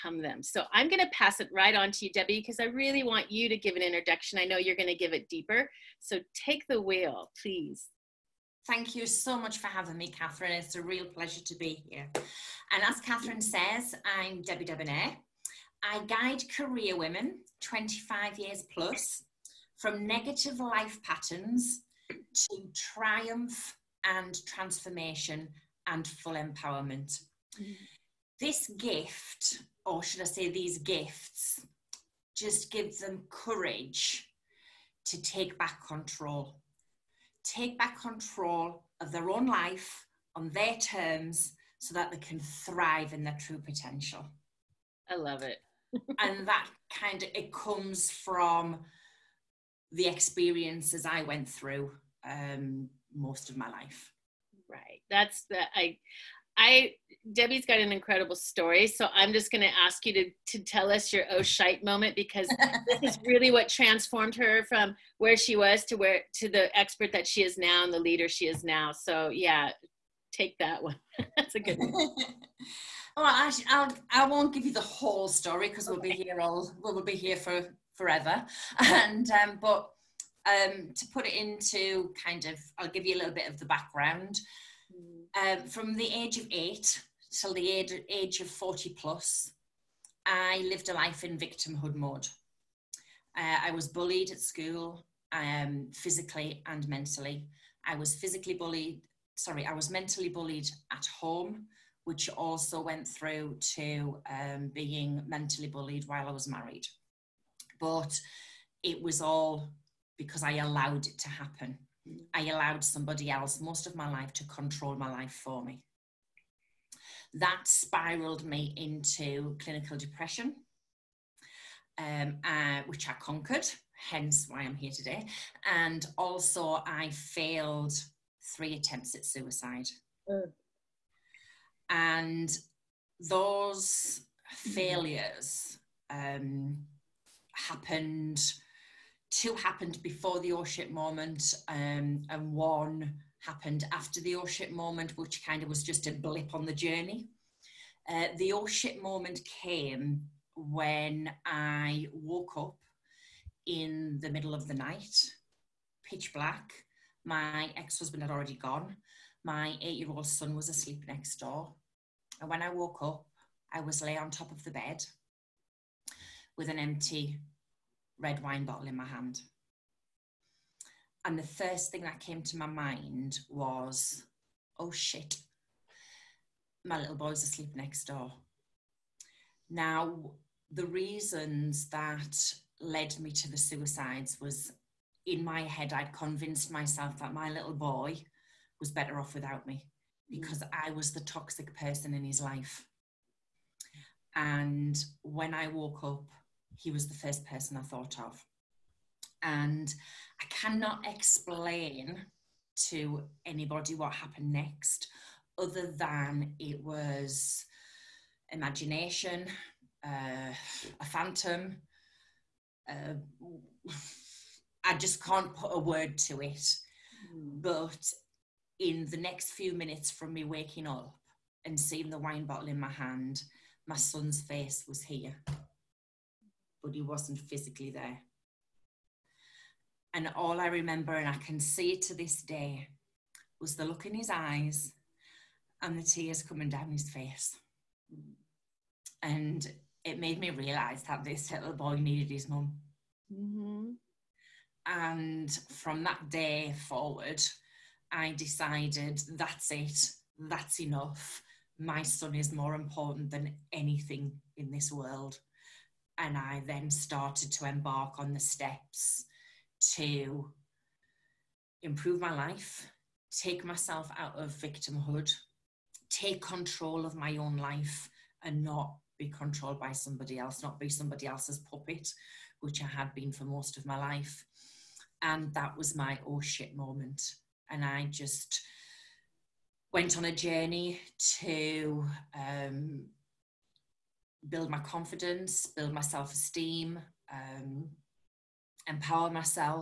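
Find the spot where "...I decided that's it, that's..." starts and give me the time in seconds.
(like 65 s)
248 s.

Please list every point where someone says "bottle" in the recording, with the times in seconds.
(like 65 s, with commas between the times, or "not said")
168 s, 222 s.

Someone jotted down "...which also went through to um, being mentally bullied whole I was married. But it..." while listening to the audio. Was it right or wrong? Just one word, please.
wrong.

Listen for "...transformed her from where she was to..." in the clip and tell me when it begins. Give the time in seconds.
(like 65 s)
63 s.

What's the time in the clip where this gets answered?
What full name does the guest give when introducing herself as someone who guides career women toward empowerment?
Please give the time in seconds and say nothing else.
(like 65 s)
14 s.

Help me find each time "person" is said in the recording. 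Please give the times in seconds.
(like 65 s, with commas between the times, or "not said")
191 s, 197 s.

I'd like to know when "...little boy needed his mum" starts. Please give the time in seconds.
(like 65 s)
241 s.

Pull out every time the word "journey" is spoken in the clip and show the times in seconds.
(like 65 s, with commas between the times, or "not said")
146 s, 280 s.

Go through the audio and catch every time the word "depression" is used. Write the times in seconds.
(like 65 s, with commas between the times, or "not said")
119 s.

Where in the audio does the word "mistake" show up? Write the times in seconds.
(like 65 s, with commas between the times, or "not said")
not said.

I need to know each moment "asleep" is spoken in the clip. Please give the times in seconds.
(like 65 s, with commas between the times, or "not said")
160 s, 177 s.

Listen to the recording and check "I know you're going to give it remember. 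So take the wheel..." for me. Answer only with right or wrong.
wrong.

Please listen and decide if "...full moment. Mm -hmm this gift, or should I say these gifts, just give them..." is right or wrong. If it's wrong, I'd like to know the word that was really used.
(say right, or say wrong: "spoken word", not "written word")
wrong: "empowerment", not "moment".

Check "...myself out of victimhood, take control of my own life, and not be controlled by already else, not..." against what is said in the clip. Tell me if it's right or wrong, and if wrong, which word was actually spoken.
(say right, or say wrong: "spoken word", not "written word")
wrong: "somebody", not "already".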